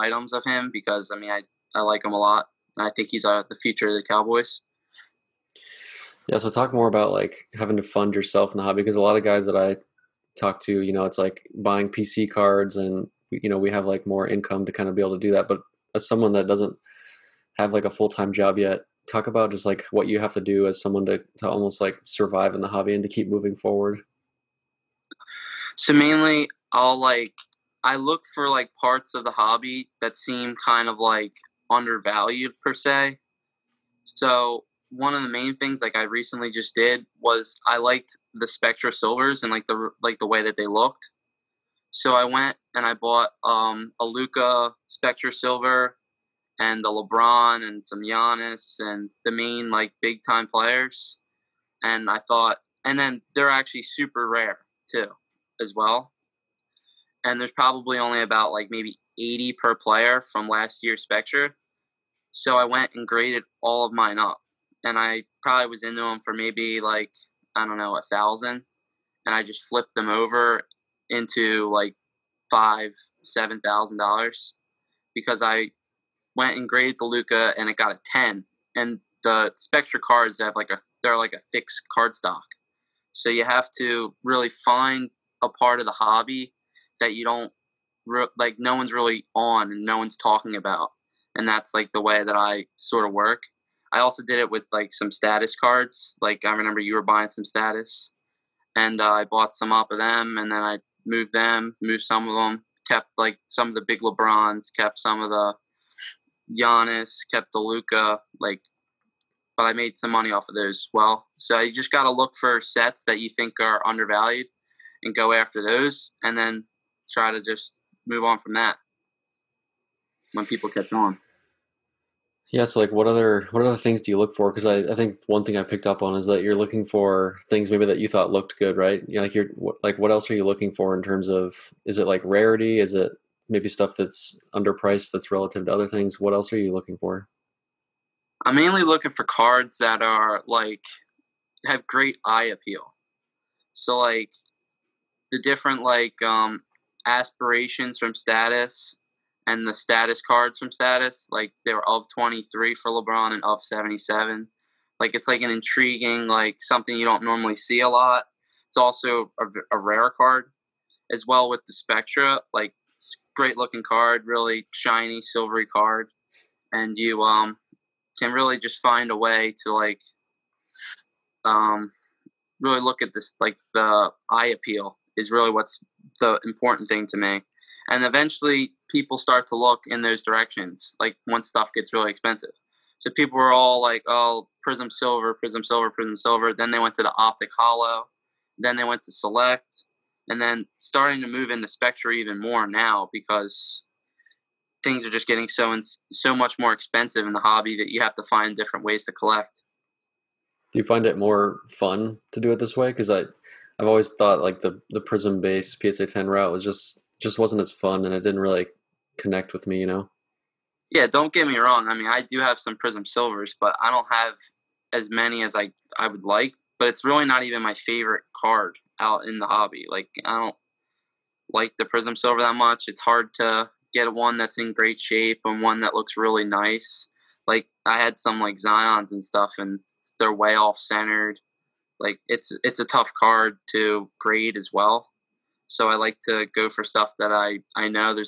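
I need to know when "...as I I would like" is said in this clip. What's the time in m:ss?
3:35.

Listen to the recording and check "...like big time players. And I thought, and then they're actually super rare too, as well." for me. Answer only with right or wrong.
right.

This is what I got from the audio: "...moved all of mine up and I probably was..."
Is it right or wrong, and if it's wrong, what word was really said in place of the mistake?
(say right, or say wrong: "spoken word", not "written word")
wrong: "graded", not "moved".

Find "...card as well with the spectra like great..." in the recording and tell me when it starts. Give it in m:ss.
2:40.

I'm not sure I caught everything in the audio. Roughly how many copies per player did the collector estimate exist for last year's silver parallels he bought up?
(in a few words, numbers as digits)
80.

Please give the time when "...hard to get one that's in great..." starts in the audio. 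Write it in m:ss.
3:43.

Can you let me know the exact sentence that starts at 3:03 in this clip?
So people were all like, oh, Prizm Silver, Prizm Silver, Prizm Silver.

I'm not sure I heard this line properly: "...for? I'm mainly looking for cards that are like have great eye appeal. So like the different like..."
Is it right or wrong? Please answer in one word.
right.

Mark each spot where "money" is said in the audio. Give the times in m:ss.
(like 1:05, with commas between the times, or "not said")
1:50.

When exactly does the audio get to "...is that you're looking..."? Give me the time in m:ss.
2:06.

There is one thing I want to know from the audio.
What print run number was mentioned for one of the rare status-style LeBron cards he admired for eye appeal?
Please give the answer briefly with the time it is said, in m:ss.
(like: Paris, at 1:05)
23, at 2:32.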